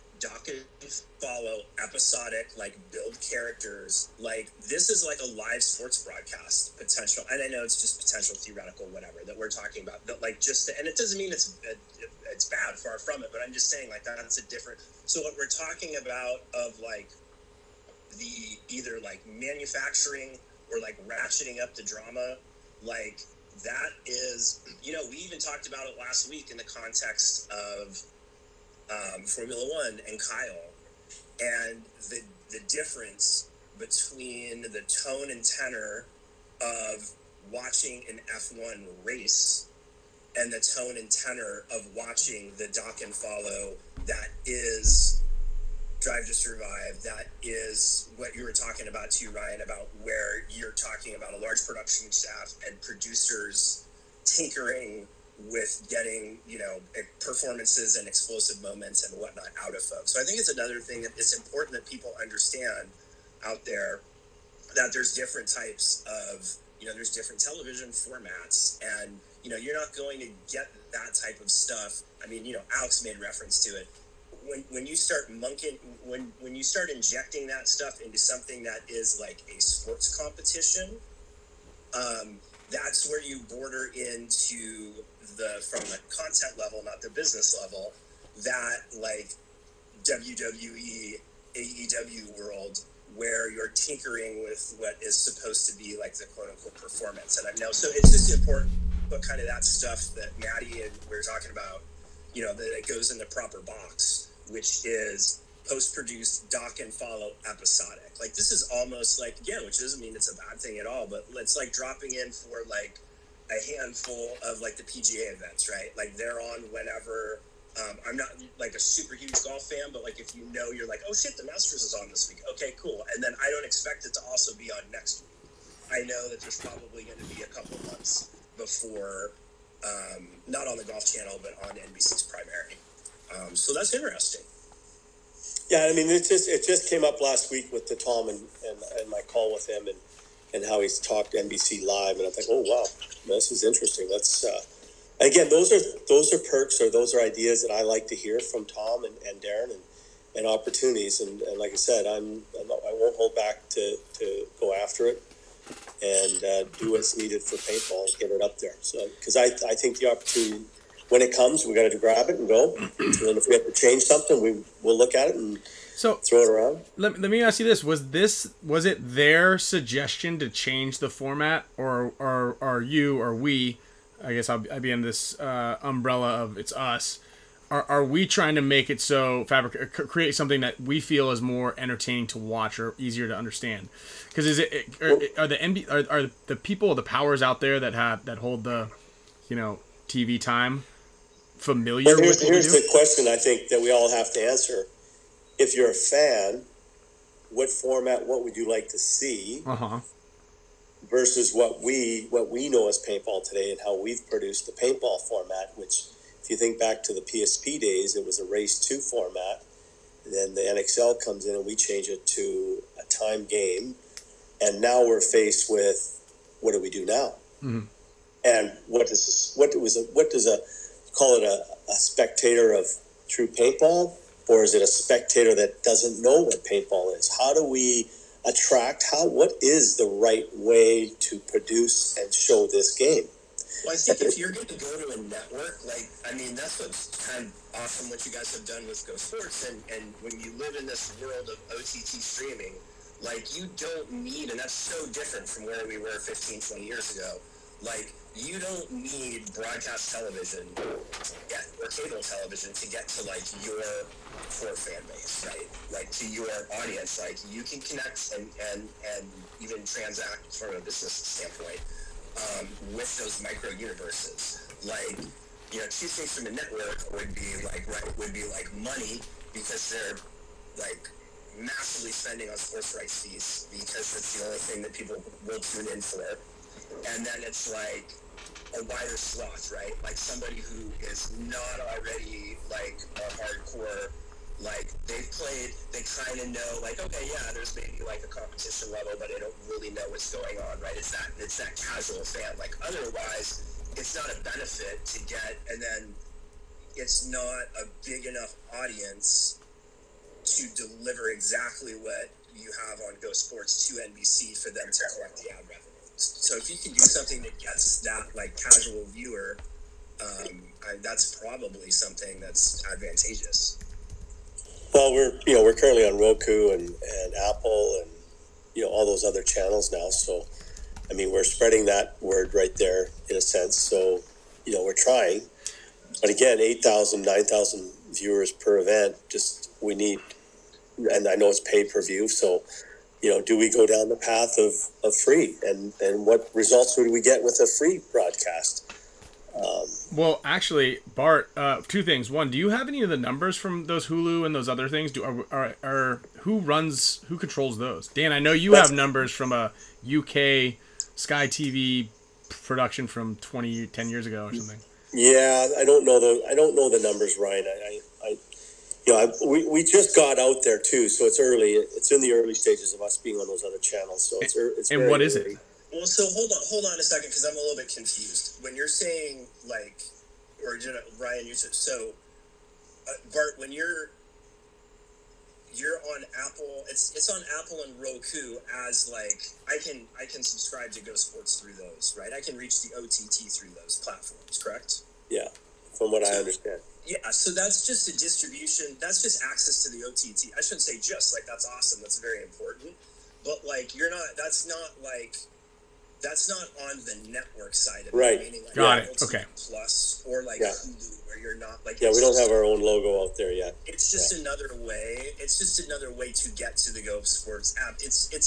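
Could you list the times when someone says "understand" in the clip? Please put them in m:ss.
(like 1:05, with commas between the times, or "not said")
1:02, 3:03, 6:26.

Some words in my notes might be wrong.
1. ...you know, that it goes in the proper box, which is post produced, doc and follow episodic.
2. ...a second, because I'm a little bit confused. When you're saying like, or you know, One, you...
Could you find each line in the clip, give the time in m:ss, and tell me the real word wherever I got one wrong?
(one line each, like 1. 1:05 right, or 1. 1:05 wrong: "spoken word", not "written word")
1. 1:42 right
2. 6:06 wrong: "Ryan", not "One".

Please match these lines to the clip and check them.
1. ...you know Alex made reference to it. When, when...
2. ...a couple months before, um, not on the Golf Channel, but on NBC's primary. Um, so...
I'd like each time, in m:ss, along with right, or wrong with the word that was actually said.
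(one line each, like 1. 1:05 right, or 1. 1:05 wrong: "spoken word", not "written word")
1. 1:12 right
2. 2:07 right.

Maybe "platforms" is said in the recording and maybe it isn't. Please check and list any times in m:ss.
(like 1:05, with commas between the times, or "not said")
6:24.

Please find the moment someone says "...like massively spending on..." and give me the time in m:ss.
4:30.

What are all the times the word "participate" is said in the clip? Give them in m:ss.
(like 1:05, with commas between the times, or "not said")
not said.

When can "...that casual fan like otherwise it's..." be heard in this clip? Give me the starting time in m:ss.
4:51.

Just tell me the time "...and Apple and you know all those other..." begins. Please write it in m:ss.
5:16.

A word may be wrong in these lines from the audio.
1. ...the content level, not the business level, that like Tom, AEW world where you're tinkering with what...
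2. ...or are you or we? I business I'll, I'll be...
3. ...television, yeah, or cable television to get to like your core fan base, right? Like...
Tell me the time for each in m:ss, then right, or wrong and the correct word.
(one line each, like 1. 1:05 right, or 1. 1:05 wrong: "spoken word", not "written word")
1. 1:25 wrong: "WWE", not "Tom"
2. 2:52 wrong: "guess", not "business"
3. 4:10 right.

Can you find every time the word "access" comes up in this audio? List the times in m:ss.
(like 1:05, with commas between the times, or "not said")
6:29.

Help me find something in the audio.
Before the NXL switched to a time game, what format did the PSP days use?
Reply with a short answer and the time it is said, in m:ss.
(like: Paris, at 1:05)
race two format, at 3:28.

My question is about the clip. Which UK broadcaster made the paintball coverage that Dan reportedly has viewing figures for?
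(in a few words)
Sky TV.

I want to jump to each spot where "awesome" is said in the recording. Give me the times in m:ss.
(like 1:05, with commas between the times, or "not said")
3:57, 6:31.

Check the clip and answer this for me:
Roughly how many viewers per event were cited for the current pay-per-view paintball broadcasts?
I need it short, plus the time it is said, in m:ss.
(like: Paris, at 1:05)
8,000 to 9,000, at 5:26.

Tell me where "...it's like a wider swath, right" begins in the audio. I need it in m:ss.
4:37.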